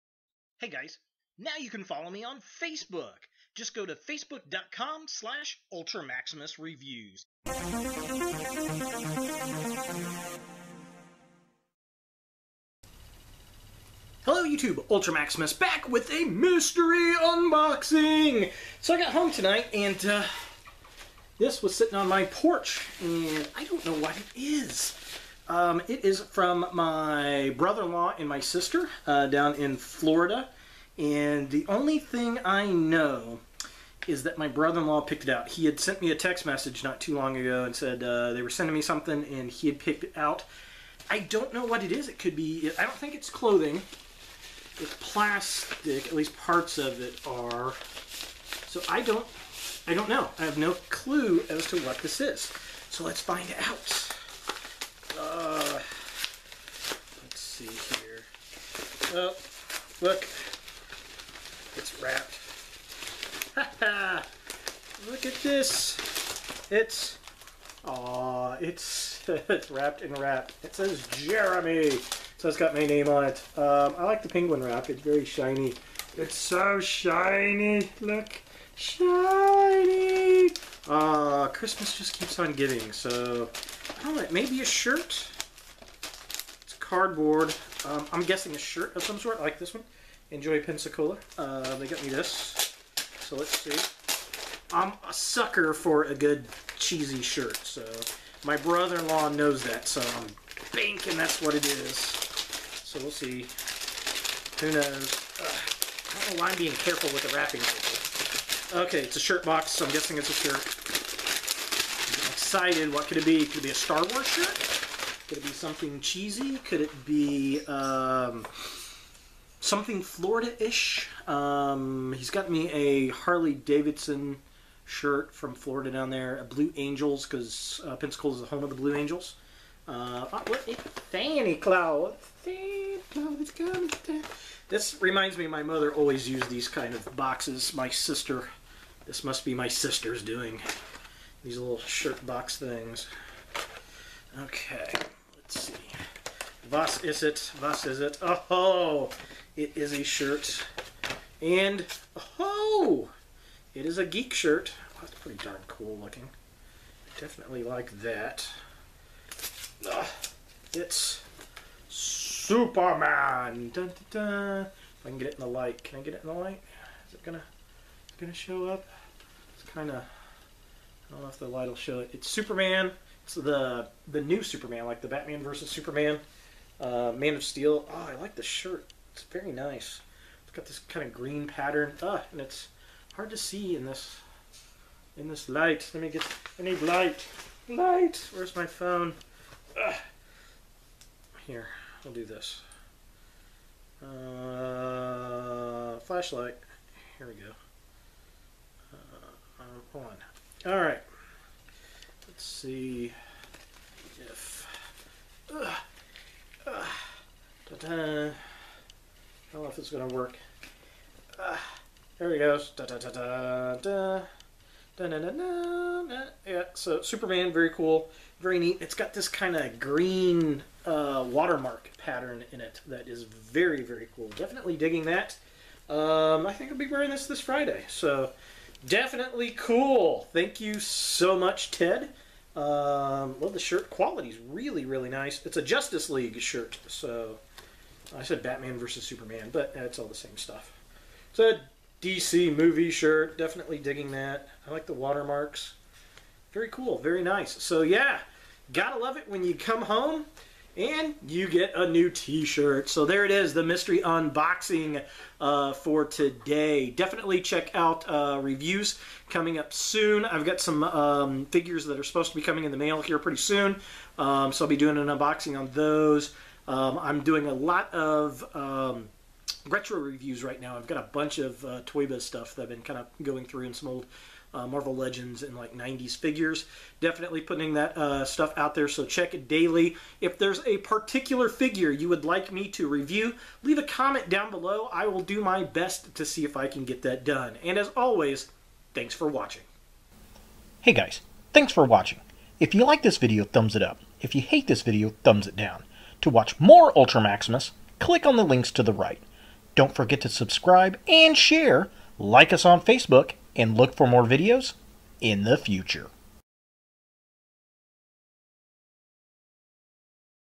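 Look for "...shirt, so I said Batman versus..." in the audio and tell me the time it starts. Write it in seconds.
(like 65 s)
236 s.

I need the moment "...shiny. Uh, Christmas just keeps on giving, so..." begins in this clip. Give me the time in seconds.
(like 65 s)
78 s.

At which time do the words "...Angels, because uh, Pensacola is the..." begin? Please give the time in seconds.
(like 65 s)
126 s.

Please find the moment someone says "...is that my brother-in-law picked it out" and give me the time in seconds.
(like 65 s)
34 s.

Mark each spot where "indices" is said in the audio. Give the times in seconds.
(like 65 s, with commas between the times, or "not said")
not said.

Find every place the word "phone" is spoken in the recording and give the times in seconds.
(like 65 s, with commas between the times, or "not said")
188 s.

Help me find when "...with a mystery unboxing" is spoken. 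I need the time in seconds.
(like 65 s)
15 s.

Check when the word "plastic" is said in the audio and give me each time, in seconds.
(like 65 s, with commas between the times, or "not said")
44 s.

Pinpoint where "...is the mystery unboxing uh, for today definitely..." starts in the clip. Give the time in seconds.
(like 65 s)
253 s.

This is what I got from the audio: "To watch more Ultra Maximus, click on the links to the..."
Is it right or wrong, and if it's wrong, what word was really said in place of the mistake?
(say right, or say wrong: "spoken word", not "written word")
right.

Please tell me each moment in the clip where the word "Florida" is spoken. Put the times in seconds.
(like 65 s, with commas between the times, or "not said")
29 s, 120 s, 125 s.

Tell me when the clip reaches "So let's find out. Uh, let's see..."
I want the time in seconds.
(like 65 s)
52 s.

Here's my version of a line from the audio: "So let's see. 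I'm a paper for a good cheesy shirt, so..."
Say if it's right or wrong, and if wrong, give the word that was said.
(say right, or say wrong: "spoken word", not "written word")
wrong: "sucker", not "paper".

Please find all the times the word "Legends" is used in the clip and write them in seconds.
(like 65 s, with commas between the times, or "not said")
274 s.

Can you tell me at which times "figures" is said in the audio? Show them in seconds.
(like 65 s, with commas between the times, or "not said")
261 s, 276 s, 281 s.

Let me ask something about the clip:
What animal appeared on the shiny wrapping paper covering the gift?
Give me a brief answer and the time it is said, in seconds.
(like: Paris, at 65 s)
Penguin, at 74 s.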